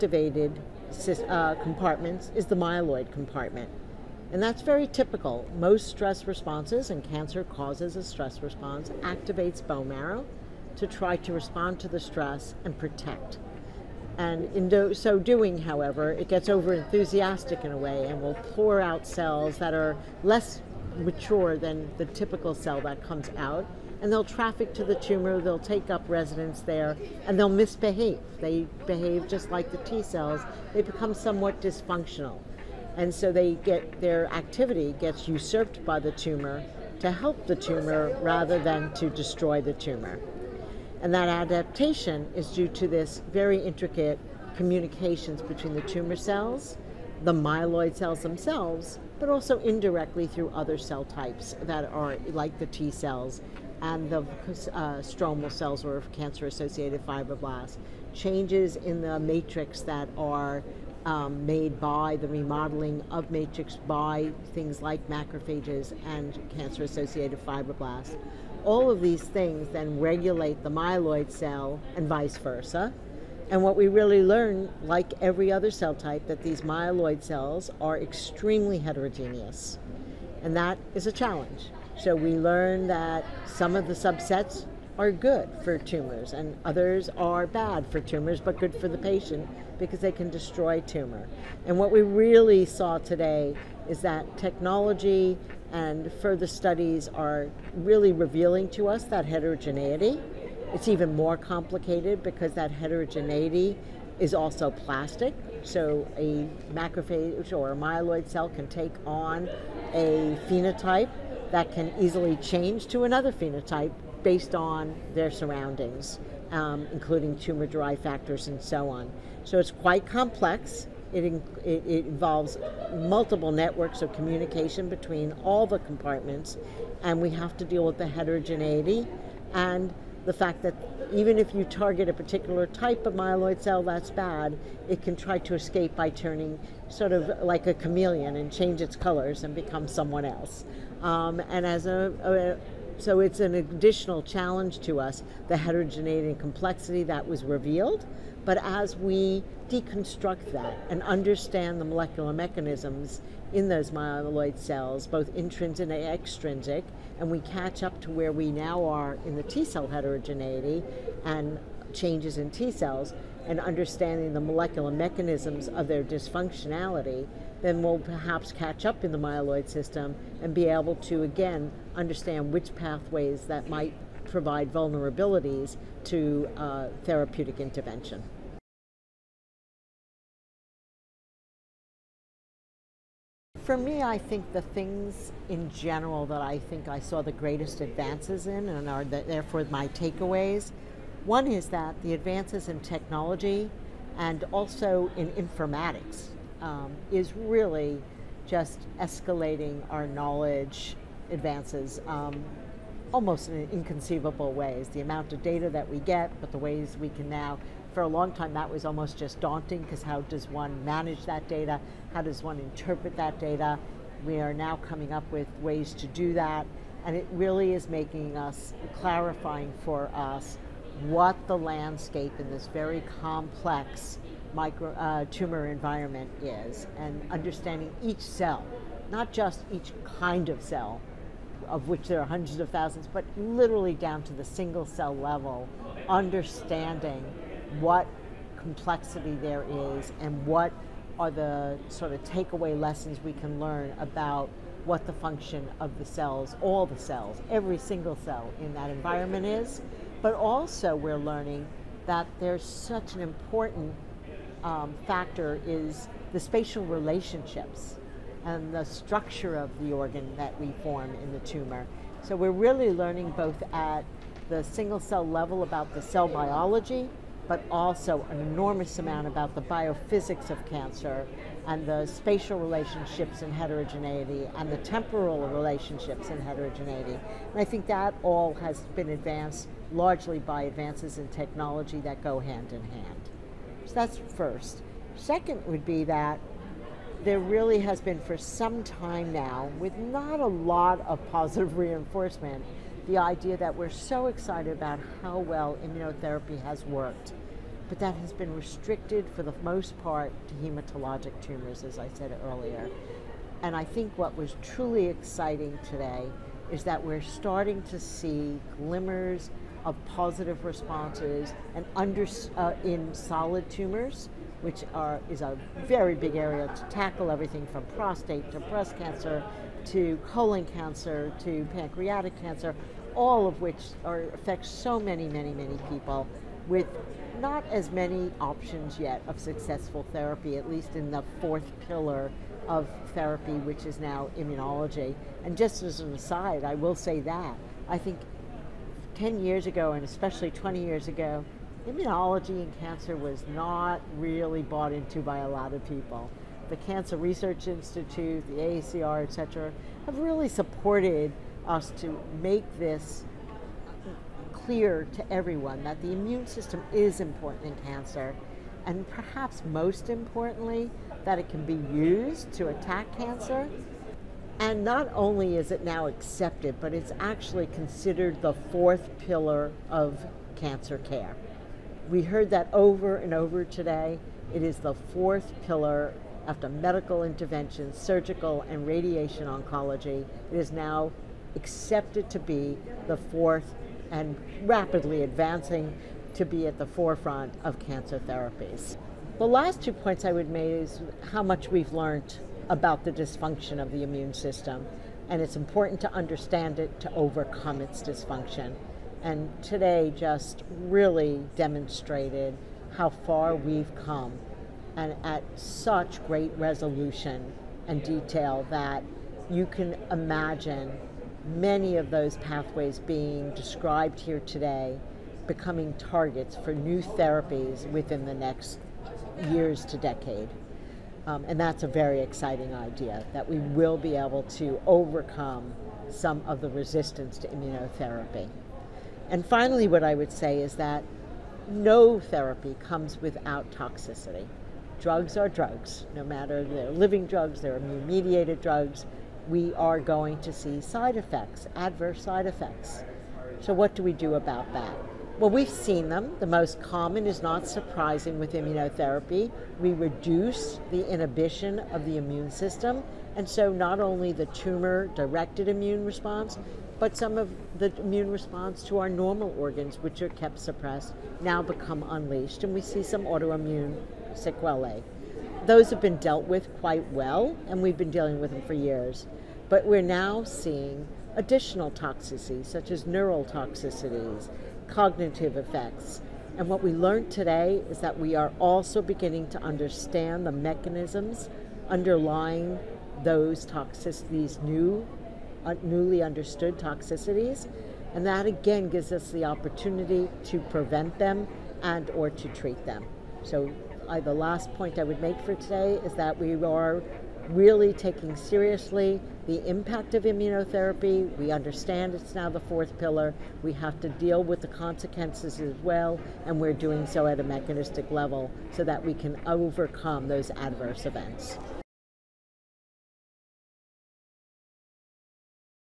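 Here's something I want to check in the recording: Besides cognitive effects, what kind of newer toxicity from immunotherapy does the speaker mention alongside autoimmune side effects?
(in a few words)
neural toxicities.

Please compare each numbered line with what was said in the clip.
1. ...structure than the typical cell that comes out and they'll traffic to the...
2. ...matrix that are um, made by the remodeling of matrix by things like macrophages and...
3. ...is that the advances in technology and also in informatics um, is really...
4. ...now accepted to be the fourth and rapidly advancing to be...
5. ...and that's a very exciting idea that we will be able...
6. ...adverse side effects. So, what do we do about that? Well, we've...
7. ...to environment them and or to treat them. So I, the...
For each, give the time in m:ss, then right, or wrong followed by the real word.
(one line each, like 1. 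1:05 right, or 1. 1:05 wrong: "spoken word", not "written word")
1. 0:20 wrong: "mature", not "structure"
2. 0:59 right
3. 3:11 right
4. 6:20 right
5. 7:01 right
6. 7:21 right
7. 8:10 wrong: "prevent", not "environment".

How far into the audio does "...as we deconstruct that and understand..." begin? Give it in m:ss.
2:28.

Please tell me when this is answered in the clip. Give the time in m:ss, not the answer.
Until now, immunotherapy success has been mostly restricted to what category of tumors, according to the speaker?
5:00.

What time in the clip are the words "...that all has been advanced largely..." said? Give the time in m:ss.
4:37.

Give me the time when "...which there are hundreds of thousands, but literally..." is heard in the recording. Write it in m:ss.
3:51.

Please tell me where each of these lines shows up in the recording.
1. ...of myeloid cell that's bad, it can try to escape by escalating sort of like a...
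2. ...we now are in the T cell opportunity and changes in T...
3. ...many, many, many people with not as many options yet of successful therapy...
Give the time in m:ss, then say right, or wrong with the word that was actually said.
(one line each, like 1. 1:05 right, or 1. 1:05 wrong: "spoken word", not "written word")
1. 2:13 wrong: "turning", not "escalating"
2. 2:38 wrong: "heterogeneity", not "opportunity"
3. 5:24 right.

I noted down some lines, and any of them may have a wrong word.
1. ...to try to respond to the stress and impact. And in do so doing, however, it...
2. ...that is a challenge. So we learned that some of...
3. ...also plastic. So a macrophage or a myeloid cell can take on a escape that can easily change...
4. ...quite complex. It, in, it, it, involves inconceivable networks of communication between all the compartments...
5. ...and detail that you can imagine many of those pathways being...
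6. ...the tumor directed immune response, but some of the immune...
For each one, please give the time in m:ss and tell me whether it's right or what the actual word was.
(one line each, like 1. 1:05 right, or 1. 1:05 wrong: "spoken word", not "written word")
1. 0:10 wrong: "protect", not "impact"
2. 1:20 right
3. 1:44 wrong: "phenotype", not "escape"
4. 1:59 wrong: "multiple", not "inconceivable"
5. 6:47 right
6. 7:34 right.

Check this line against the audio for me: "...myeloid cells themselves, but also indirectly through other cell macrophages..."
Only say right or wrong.
wrong.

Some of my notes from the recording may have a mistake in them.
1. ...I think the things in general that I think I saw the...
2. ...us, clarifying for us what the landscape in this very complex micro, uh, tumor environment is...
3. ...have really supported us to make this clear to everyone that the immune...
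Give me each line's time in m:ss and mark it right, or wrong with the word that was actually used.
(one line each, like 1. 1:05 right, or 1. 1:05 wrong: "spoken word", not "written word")
1. 3:04 right
2. 3:38 right
3. 5:50 right.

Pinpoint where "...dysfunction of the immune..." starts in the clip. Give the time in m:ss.
6:33.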